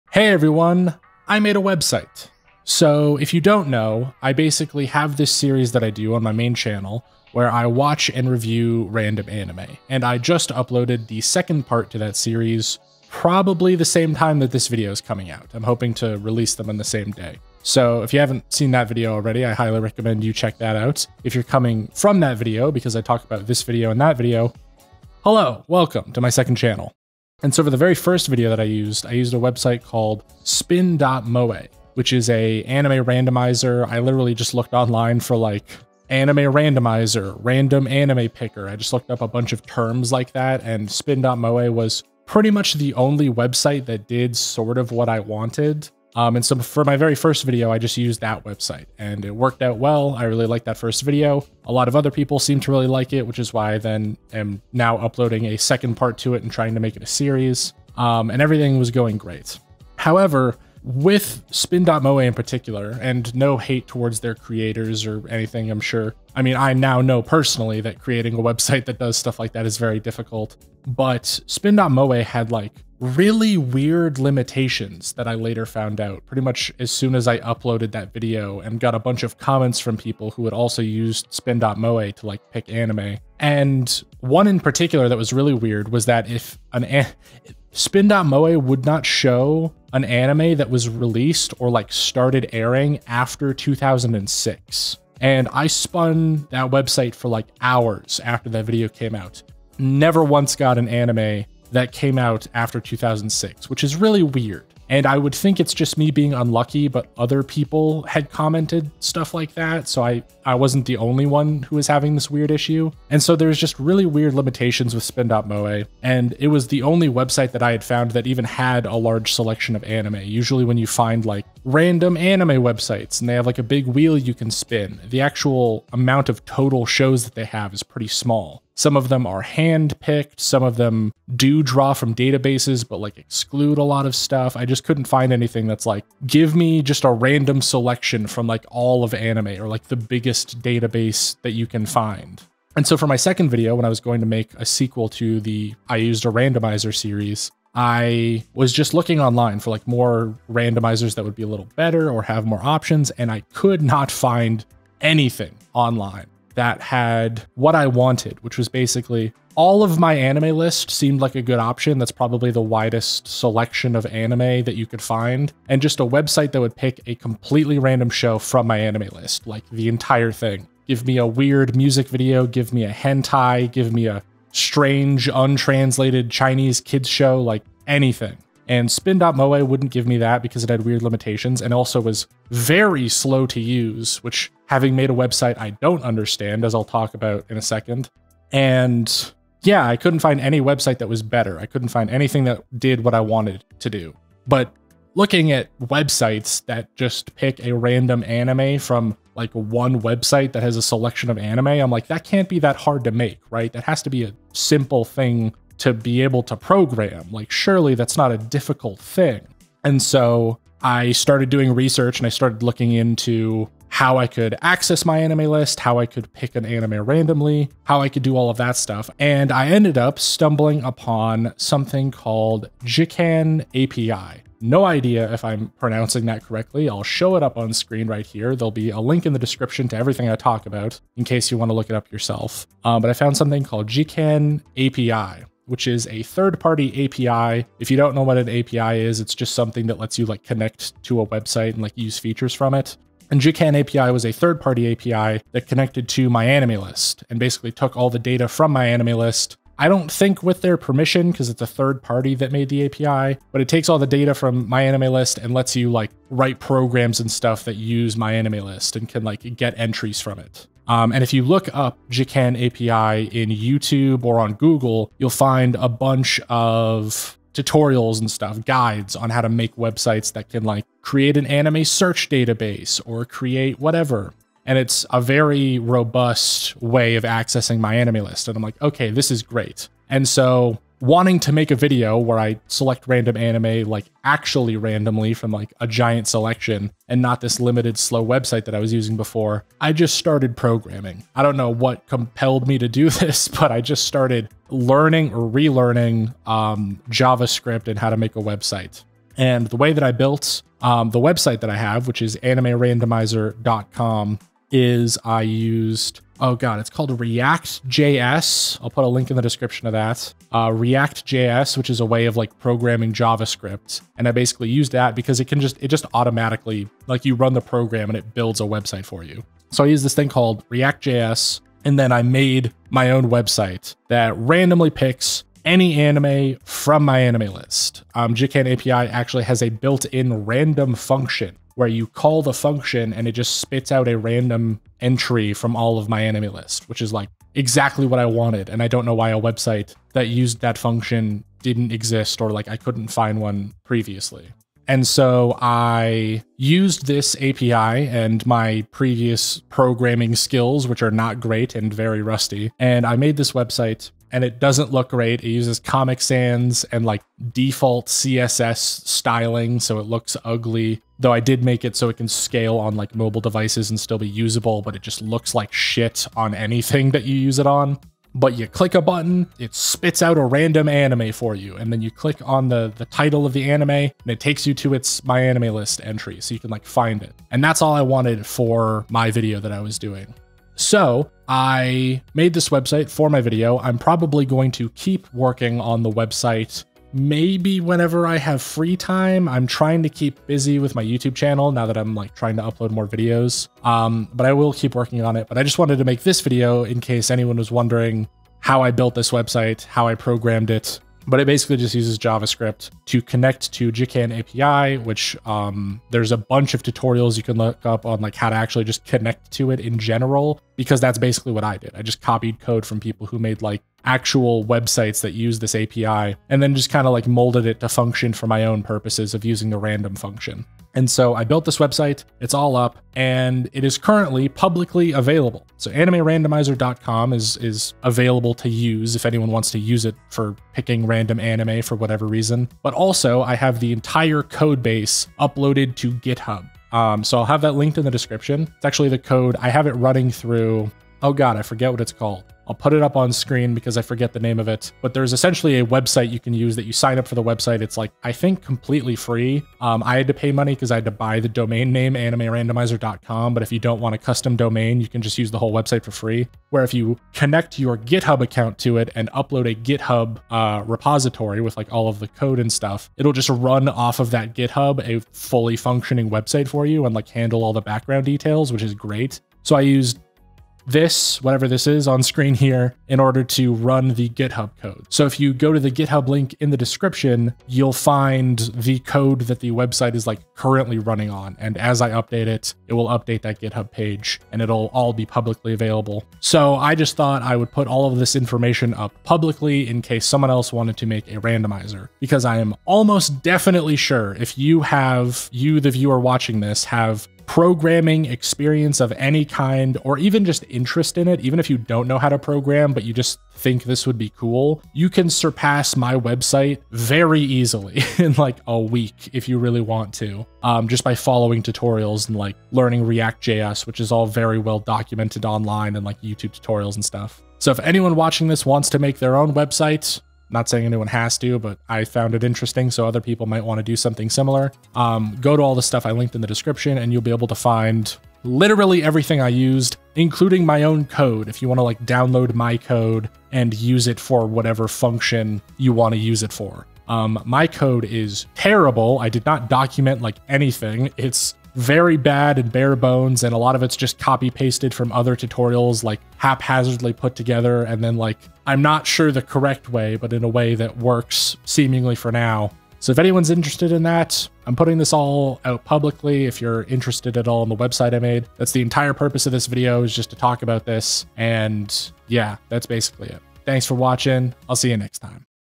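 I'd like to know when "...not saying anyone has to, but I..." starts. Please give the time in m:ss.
8:40.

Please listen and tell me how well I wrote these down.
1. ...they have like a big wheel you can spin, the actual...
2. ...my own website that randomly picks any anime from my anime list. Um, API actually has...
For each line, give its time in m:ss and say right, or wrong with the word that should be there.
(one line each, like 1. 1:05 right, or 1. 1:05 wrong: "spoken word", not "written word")
1. 2:03 right
2. 5:22 right.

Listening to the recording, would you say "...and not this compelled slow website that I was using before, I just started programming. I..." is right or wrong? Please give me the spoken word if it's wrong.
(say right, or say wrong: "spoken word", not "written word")
wrong: "limited", not "compelled".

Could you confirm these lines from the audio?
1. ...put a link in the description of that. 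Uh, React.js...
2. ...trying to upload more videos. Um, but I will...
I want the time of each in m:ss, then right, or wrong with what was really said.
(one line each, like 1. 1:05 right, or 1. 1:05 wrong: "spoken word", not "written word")
1. 5:08 right
2. 6:32 right.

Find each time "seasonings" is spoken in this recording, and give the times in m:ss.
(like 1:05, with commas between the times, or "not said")
not said.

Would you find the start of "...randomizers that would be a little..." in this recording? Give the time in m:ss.
2:30.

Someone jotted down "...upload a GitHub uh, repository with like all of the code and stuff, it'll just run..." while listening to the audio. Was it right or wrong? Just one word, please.
right.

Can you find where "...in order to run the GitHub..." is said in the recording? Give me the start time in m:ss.
7:53.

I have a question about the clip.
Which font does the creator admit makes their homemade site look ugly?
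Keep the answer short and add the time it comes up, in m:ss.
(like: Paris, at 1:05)
Comic Sans, at 5:55.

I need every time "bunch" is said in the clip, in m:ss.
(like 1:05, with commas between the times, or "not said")
0:39, 1:18, 4:25, 6:46.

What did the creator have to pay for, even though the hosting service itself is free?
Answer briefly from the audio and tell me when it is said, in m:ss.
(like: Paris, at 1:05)
the domain name, at 7:31.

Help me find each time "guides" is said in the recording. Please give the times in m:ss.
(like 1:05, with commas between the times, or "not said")
4:28.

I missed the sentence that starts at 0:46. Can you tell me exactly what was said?
Um, and so for my very first video, I just used that website and it worked out well.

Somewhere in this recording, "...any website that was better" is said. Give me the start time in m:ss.
3:10.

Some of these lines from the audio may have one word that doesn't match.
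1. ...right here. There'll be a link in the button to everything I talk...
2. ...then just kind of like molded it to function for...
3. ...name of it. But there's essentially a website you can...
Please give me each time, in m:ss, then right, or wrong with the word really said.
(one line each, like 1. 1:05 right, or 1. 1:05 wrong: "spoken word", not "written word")
1. 3:48 wrong: "description", not "button"
2. 6:56 right
3. 7:24 right.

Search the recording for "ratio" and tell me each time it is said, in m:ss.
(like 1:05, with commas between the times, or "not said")
not said.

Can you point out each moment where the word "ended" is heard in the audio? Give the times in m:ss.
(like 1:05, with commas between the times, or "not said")
3:39.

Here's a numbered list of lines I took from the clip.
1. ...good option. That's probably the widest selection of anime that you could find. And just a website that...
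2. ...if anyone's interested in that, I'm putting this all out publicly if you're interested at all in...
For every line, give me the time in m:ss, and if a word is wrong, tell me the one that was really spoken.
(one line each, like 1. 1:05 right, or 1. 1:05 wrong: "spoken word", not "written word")
1. 2:41 right
2. 9:13 right.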